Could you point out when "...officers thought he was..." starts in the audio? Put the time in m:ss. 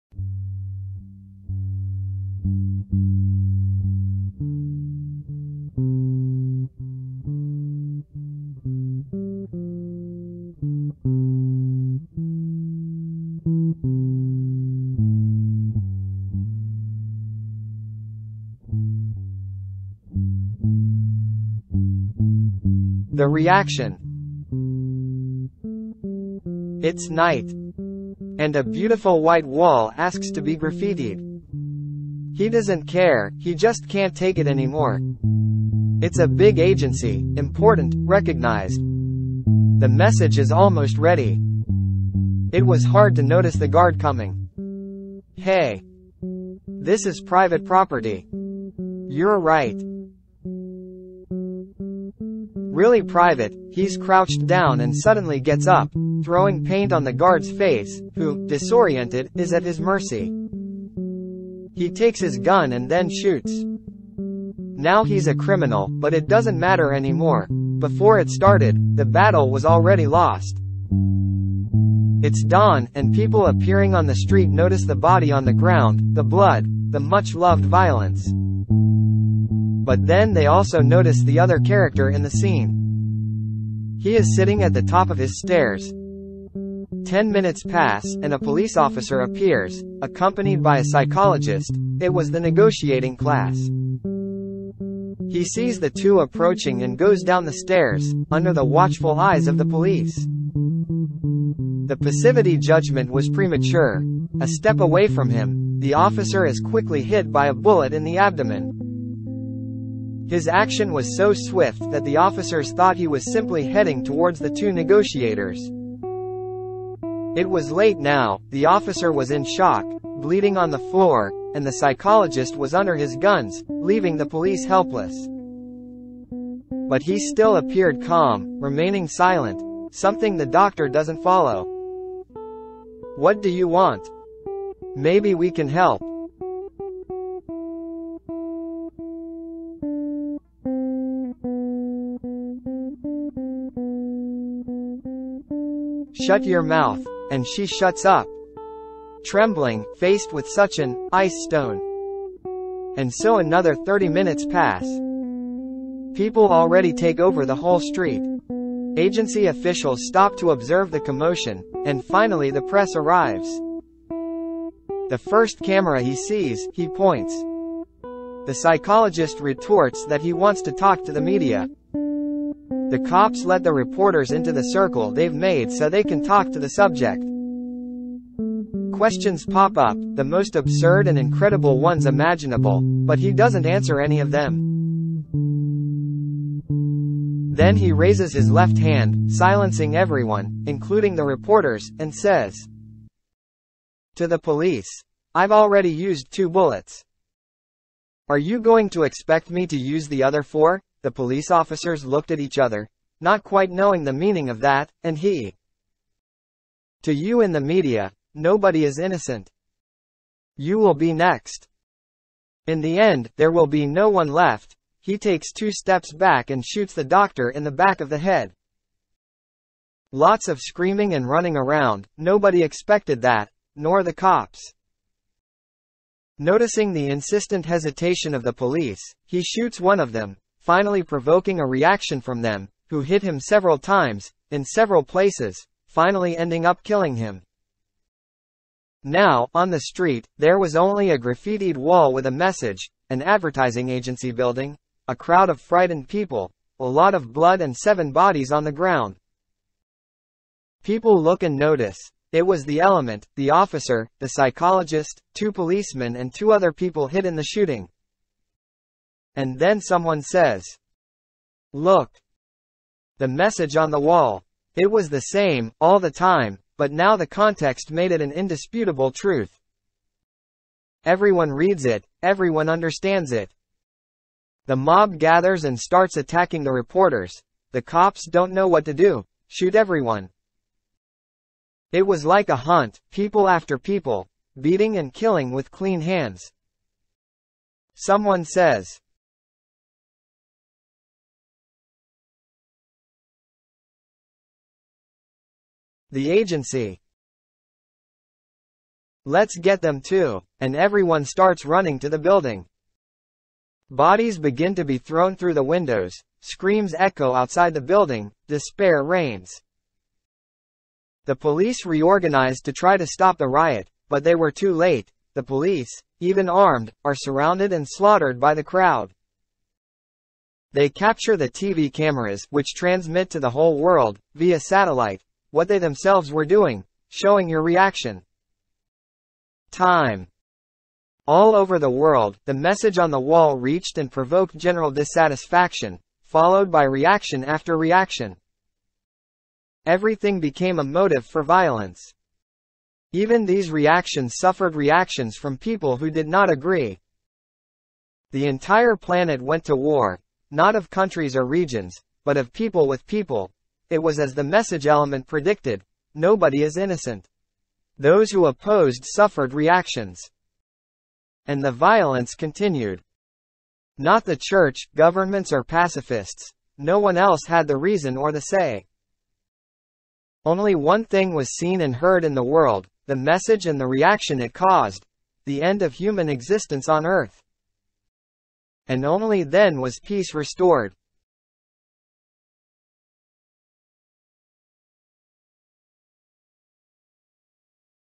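1:52.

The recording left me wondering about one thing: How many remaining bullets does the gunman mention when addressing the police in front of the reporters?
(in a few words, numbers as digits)
4.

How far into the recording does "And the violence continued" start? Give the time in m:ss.
6:01.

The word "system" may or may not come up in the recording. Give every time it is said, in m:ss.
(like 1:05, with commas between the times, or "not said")
not said.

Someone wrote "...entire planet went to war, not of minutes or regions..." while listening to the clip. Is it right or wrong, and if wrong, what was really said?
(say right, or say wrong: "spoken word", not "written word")
wrong: "countries", not "minutes".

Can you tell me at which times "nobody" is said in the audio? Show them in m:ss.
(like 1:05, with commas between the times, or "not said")
3:28, 3:42, 5:56.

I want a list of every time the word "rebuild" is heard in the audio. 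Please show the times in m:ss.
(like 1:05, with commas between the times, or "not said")
not said.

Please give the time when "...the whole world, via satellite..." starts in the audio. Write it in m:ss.
5:23.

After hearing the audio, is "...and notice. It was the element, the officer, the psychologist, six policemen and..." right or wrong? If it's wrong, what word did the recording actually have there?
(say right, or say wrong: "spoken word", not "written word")
wrong: "two", not "six".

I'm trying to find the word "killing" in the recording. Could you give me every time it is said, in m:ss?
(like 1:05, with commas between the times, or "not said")
3:56, 4:45.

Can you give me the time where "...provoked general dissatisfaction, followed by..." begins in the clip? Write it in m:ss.
5:34.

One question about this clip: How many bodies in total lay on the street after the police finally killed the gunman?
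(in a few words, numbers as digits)
7.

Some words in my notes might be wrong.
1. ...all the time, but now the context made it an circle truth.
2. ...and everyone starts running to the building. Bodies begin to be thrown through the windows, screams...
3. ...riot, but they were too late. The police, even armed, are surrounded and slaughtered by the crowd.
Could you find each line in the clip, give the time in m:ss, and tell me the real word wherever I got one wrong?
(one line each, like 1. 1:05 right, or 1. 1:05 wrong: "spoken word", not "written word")
1. 4:25 wrong: "indisputable", not "circle"
2. 5:00 right
3. 5:13 right.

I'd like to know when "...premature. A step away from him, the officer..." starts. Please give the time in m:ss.
1:43.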